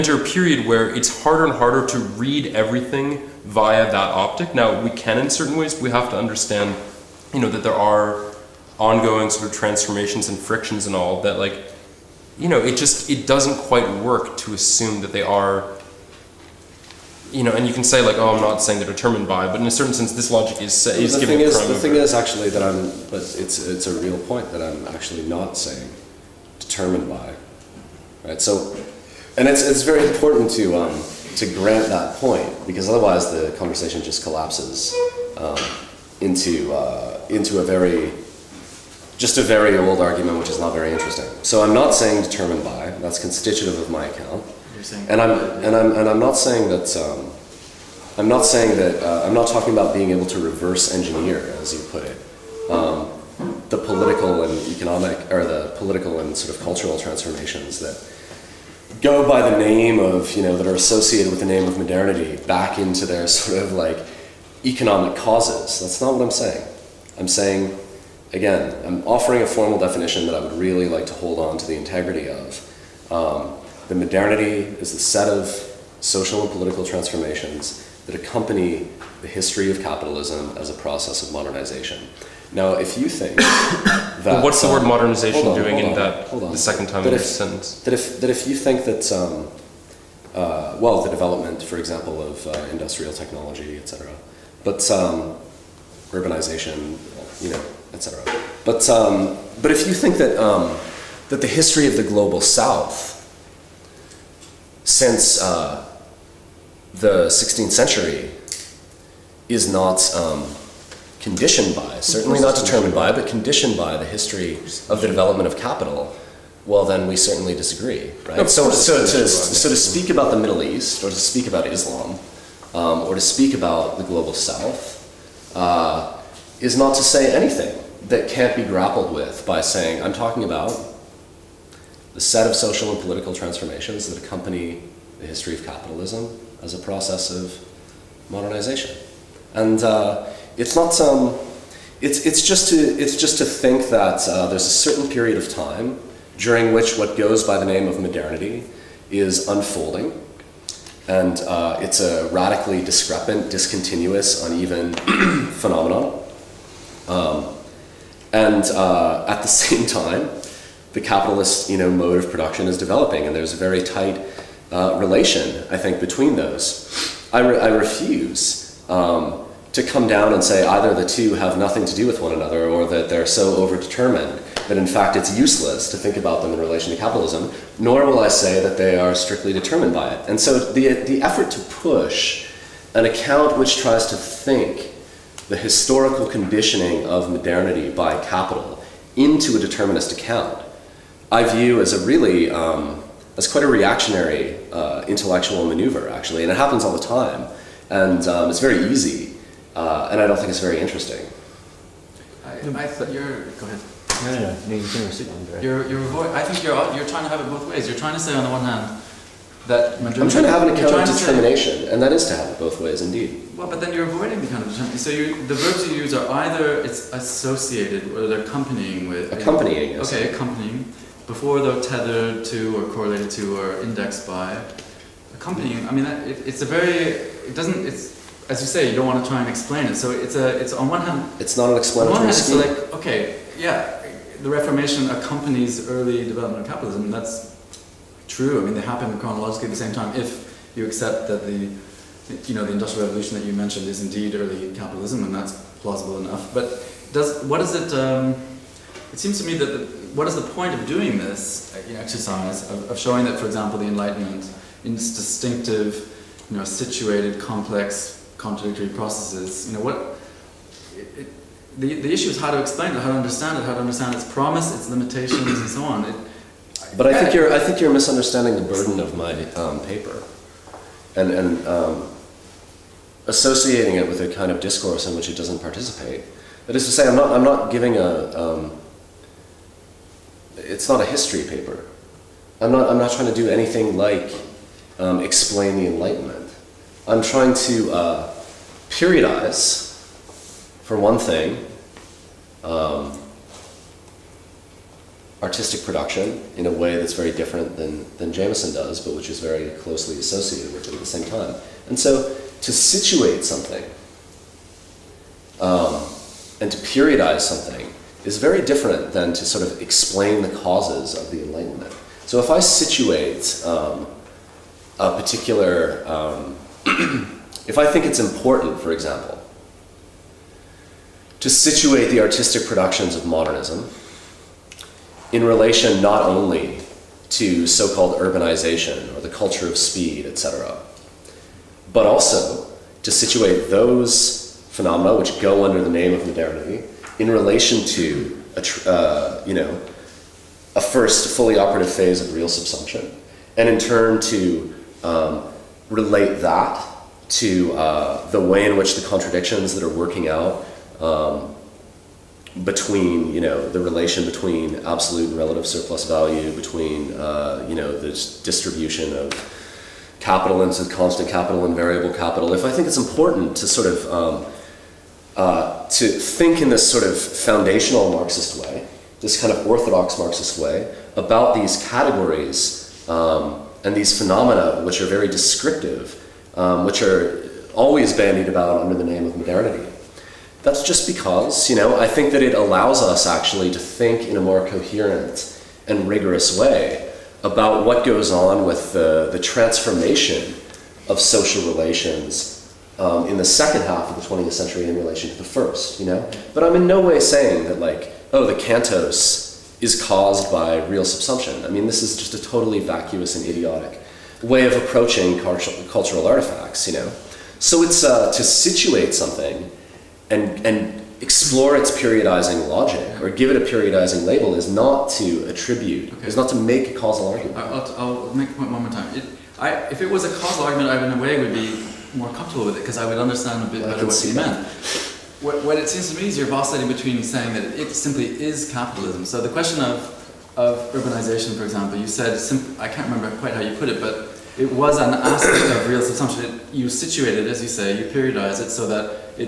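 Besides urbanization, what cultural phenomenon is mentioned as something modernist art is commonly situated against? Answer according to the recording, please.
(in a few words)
the culture of speed.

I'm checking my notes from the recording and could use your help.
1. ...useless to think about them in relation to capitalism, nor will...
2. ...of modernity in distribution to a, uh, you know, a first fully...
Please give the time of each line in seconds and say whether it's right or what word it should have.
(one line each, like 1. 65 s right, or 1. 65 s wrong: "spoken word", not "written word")
1. 175 s right
2. 336 s wrong: "relation", not "distribution".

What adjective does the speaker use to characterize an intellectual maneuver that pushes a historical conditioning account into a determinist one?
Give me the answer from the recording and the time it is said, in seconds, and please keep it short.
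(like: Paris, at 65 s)
reactionary, at 193 s.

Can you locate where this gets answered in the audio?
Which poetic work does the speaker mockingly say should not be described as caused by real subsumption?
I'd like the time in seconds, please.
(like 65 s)
398 s.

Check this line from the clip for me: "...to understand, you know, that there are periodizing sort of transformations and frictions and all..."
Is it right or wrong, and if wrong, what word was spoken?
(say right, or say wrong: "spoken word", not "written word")
wrong: "ongoing", not "periodizing".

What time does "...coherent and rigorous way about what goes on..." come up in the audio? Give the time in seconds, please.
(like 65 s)
384 s.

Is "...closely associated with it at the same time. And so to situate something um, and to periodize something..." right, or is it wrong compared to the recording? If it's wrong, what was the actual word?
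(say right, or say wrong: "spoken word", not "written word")
right.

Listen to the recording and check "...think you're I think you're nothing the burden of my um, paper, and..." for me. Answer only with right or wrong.
wrong.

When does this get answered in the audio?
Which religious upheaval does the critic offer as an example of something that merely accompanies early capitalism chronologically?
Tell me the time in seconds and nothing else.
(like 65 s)
234 s.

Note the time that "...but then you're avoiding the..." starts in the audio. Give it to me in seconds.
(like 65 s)
213 s.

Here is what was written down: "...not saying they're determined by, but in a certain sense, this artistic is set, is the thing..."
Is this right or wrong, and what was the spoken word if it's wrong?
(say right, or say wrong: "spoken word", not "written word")
wrong: "logic", not "artistic".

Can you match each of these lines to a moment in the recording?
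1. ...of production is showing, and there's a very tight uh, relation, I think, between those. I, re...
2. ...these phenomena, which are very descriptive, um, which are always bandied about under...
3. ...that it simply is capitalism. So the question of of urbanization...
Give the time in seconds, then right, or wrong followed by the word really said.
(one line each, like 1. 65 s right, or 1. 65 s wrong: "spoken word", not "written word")
1. 162 s wrong: "developing", not "showing"
2. 373 s right
3. 427 s right.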